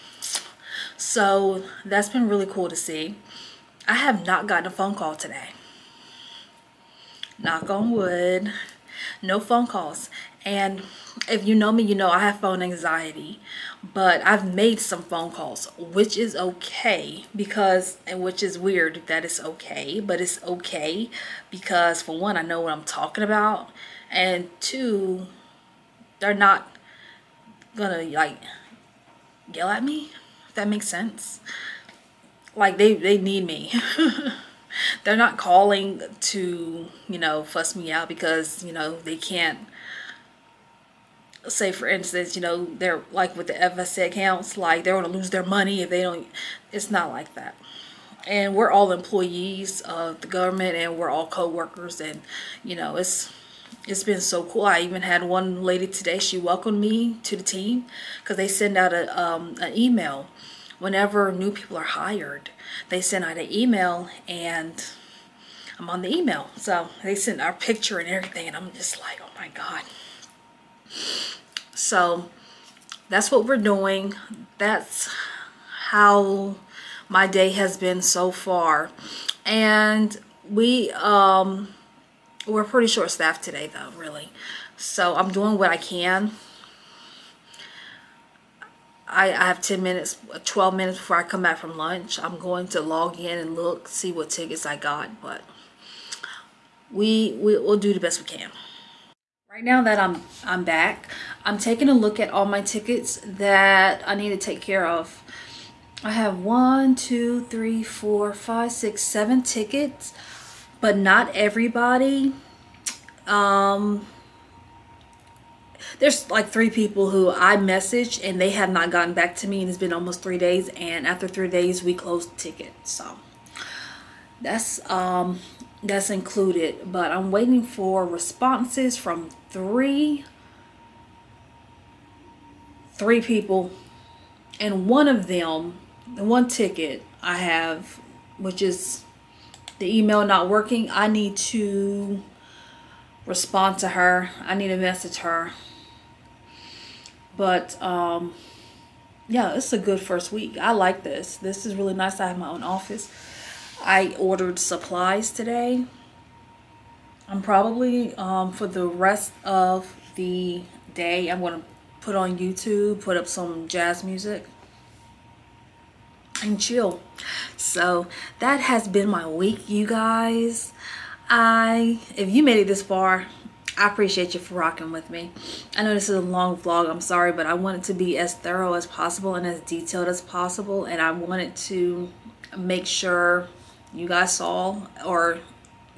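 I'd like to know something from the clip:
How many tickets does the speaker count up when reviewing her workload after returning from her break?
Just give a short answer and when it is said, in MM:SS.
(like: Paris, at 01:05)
7, at 01:48.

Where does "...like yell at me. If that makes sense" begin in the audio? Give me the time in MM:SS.
00:28.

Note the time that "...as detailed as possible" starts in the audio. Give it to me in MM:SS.
02:59.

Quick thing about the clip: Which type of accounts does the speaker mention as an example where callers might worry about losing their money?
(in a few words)
FSA accounts.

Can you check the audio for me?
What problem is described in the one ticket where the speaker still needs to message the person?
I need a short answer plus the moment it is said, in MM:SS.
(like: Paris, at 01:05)
Email not working, at 02:19.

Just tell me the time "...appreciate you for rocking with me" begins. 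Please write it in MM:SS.
02:53.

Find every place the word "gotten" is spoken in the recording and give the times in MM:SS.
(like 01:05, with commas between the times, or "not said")
00:04, 01:58.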